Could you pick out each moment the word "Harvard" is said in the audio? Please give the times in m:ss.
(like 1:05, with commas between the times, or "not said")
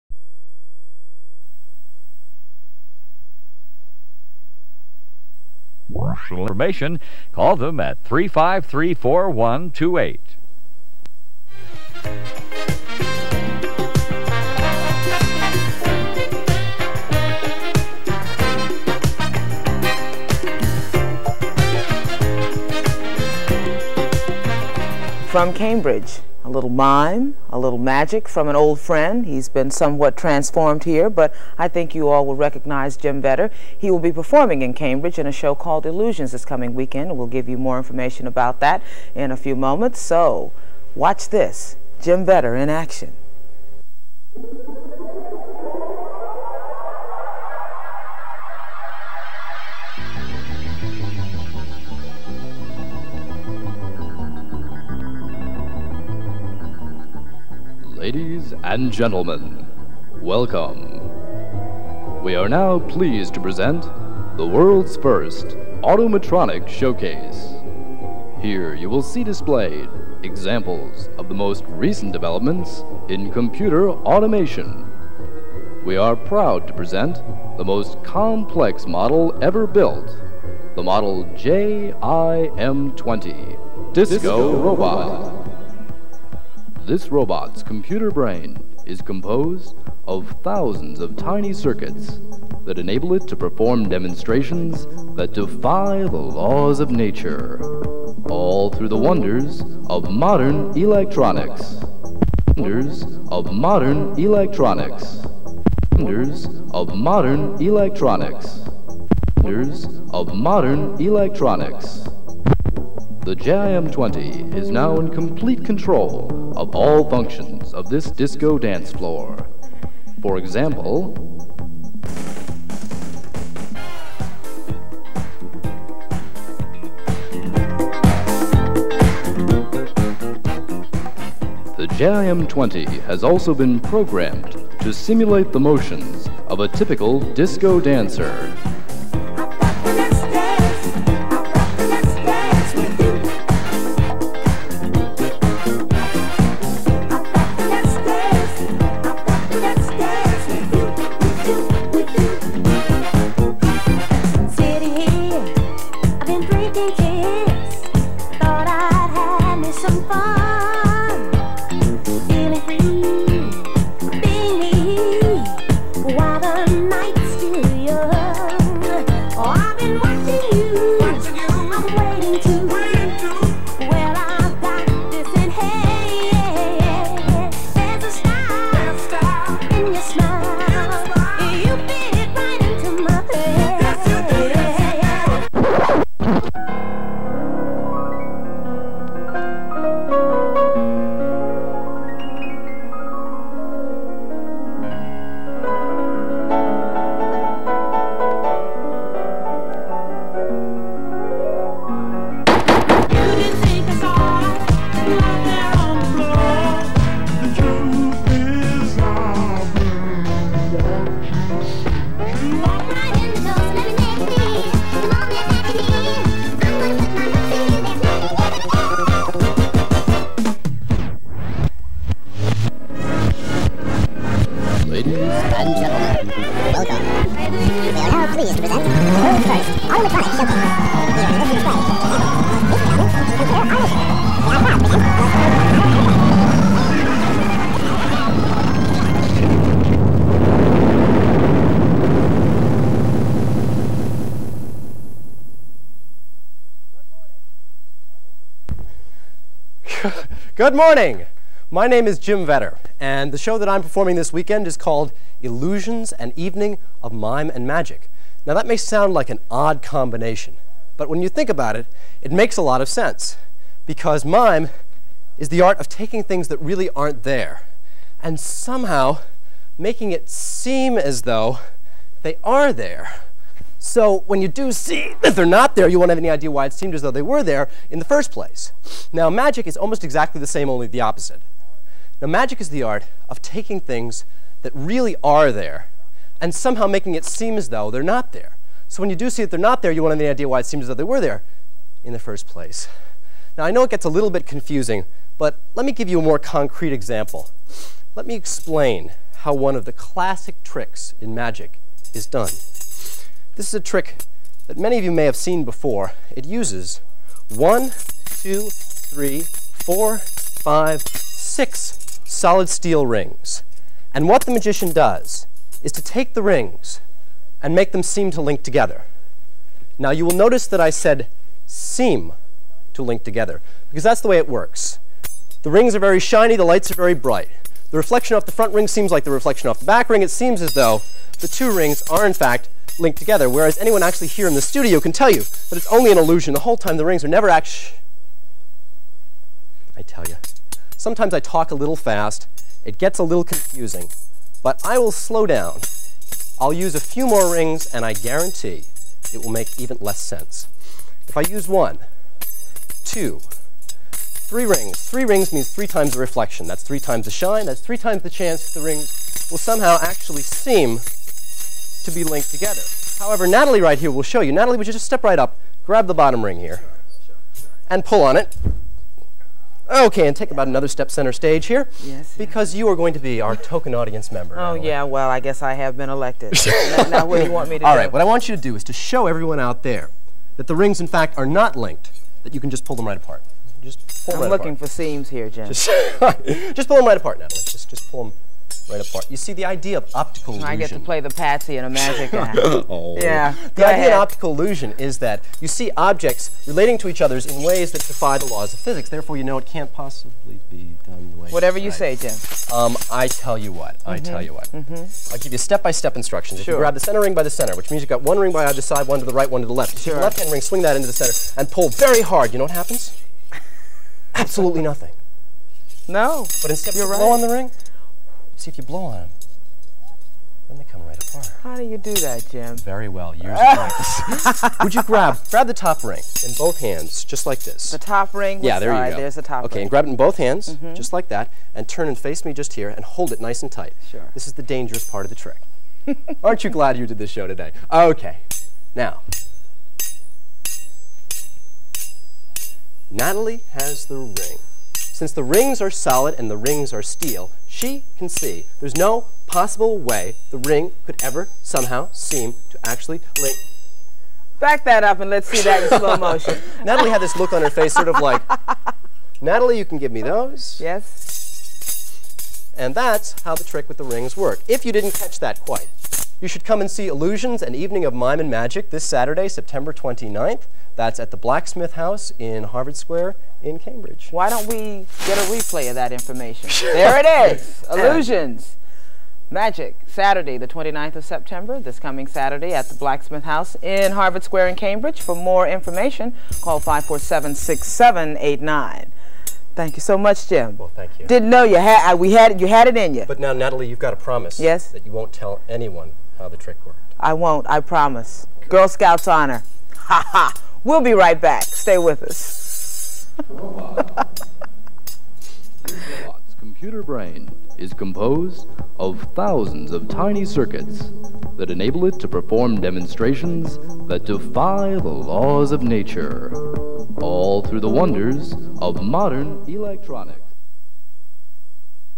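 7:52, 8:04.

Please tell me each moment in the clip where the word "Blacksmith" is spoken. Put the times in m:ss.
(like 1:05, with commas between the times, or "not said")
7:51, 8:02.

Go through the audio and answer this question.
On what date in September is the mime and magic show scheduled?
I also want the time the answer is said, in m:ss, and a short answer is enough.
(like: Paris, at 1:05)
September 29, at 7:49.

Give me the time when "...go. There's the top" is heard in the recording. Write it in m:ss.
7:09.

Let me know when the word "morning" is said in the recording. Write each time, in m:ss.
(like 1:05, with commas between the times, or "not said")
4:10.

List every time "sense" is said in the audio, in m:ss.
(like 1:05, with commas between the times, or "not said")
4:22, 5:50.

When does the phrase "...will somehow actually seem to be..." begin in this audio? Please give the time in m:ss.
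5:59.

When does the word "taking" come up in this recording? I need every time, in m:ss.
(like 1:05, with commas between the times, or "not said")
4:25, 4:43.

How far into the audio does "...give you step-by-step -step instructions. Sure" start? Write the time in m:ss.
6:45.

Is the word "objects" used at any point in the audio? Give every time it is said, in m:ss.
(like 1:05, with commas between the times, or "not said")
6:35.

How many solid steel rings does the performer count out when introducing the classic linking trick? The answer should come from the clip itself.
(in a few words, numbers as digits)
6.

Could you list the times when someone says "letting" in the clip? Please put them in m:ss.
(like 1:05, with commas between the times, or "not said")
not said.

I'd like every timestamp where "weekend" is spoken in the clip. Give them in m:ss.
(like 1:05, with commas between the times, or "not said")
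0:36, 4:14.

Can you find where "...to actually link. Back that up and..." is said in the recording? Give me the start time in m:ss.
7:32.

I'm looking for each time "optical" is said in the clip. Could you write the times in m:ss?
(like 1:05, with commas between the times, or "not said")
6:30, 6:34.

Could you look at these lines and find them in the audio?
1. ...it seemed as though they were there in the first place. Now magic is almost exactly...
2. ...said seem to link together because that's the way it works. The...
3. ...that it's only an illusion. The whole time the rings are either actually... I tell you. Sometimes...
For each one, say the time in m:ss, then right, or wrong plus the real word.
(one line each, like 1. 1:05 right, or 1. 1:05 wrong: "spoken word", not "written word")
1. 4:36 right
2. 5:20 right
3. 5:35 wrong: "never", not "either".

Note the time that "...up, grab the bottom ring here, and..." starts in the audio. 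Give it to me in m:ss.
6:05.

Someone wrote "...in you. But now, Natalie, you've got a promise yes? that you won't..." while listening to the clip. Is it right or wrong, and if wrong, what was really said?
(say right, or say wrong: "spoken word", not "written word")
right.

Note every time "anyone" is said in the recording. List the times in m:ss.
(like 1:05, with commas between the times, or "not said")
5:33, 8:15.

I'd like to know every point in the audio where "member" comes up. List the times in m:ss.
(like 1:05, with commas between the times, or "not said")
6:14.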